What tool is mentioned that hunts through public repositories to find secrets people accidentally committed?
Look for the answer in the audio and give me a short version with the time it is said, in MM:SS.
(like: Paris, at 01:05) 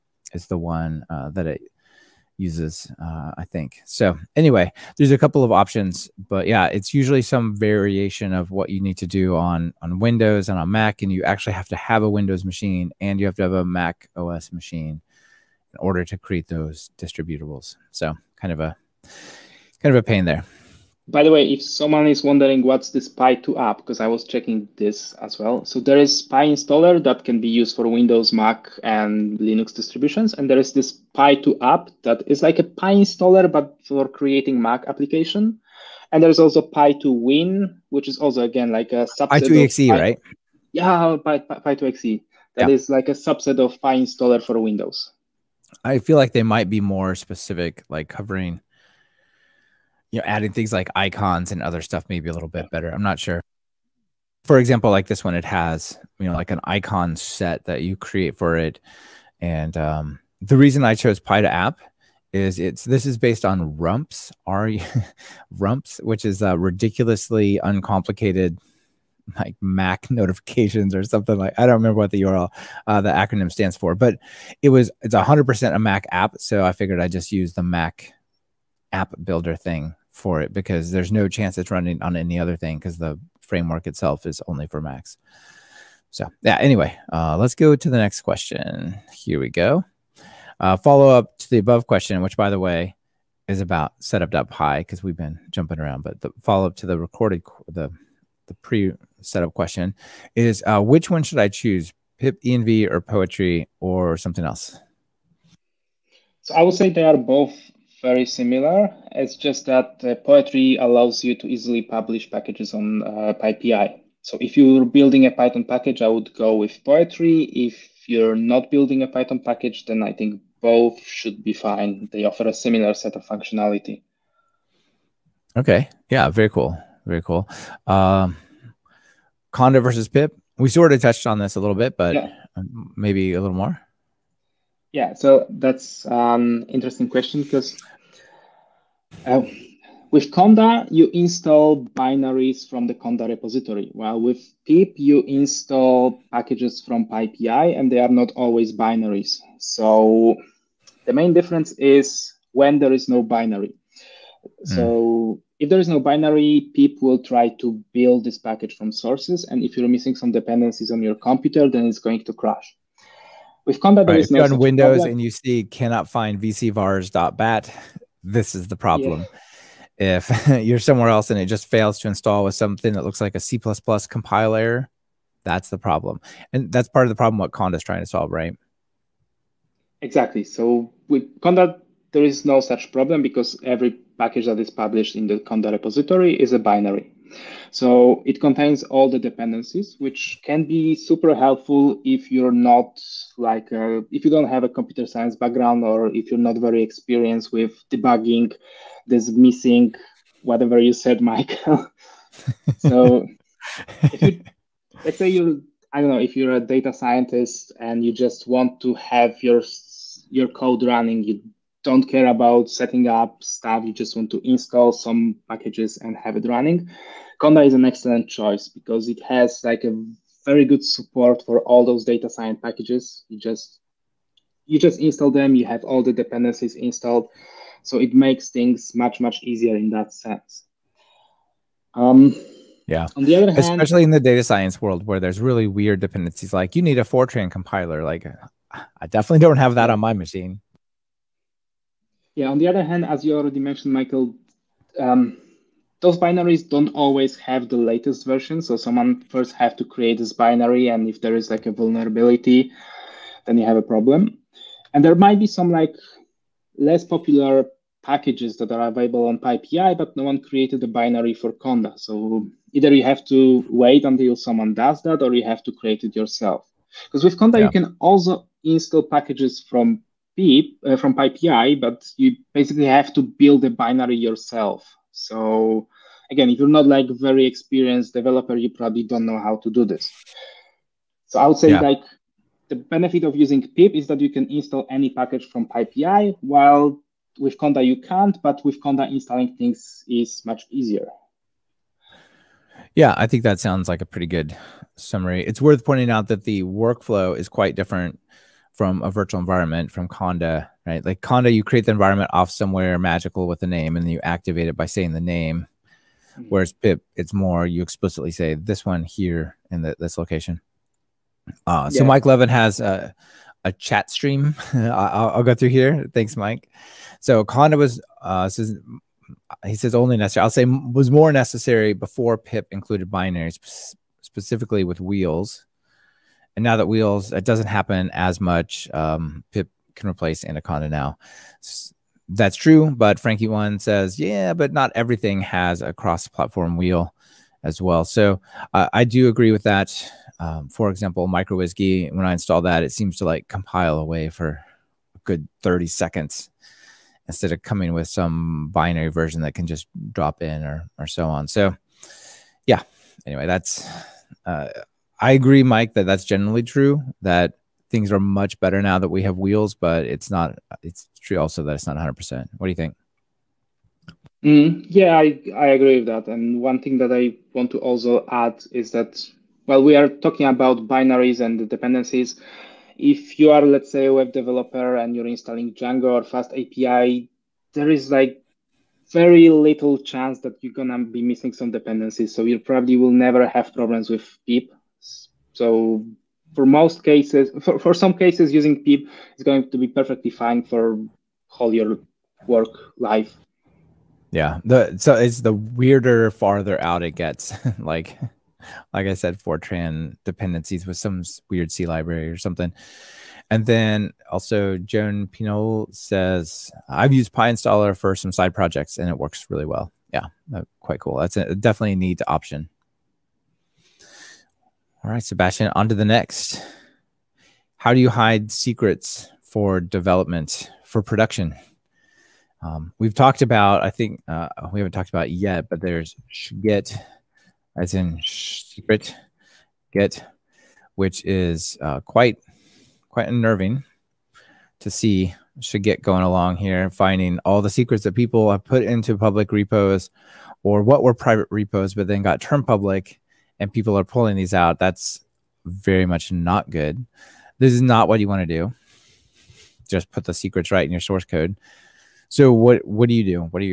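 shhgit, at 07:15.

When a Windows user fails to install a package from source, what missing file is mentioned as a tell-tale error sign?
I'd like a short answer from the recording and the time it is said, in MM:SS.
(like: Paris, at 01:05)
vcvars.bat, at 02:46.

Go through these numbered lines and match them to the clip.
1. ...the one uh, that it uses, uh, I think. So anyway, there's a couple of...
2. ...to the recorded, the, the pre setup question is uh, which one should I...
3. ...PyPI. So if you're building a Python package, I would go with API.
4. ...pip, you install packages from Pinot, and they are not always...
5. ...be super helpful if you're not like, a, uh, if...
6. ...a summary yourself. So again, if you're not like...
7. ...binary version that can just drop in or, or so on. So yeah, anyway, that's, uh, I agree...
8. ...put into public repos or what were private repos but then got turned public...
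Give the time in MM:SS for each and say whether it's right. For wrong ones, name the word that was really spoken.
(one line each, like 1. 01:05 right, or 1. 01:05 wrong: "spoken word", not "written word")
1. 00:00 right
2. 01:36 right
3. 01:53 wrong: "Poetry", not "API"
4. 02:24 wrong: "PyPI", not "Pinot"
5. 03:10 right
6. 04:33 wrong: "binary", not "summary"
7. 05:48 right
8. 07:18 right.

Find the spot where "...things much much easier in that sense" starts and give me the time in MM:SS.
03:48.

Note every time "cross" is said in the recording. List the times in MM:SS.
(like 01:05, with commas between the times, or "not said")
05:35.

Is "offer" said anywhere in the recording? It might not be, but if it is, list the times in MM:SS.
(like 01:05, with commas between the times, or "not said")
02:02.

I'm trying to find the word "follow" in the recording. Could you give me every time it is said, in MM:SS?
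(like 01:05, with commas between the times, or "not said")
01:30, 01:36.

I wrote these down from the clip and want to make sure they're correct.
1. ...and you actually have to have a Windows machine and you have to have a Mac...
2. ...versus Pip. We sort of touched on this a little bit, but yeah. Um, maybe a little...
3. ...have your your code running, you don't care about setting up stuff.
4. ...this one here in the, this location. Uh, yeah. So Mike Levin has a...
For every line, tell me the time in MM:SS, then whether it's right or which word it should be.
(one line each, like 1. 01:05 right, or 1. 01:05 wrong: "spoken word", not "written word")
1. 00:11 right
2. 02:09 right
3. 03:28 right
4. 05:08 right.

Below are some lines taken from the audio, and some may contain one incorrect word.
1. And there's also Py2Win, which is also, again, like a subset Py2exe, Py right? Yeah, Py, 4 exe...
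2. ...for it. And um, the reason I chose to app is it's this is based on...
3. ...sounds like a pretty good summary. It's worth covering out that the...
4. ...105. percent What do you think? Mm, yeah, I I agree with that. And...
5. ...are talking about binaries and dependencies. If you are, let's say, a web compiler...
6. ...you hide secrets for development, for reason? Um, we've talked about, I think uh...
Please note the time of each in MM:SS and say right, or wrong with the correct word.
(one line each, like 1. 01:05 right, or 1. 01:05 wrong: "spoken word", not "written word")
1. 00:36 wrong: "2", not "4"
2. 00:58 right
3. 04:53 wrong: "pointing", not "covering"
4. 06:01 wrong: "100", not "105"
5. 06:09 wrong: "developer", not "compiler"
6. 06:57 wrong: "production", not "reason".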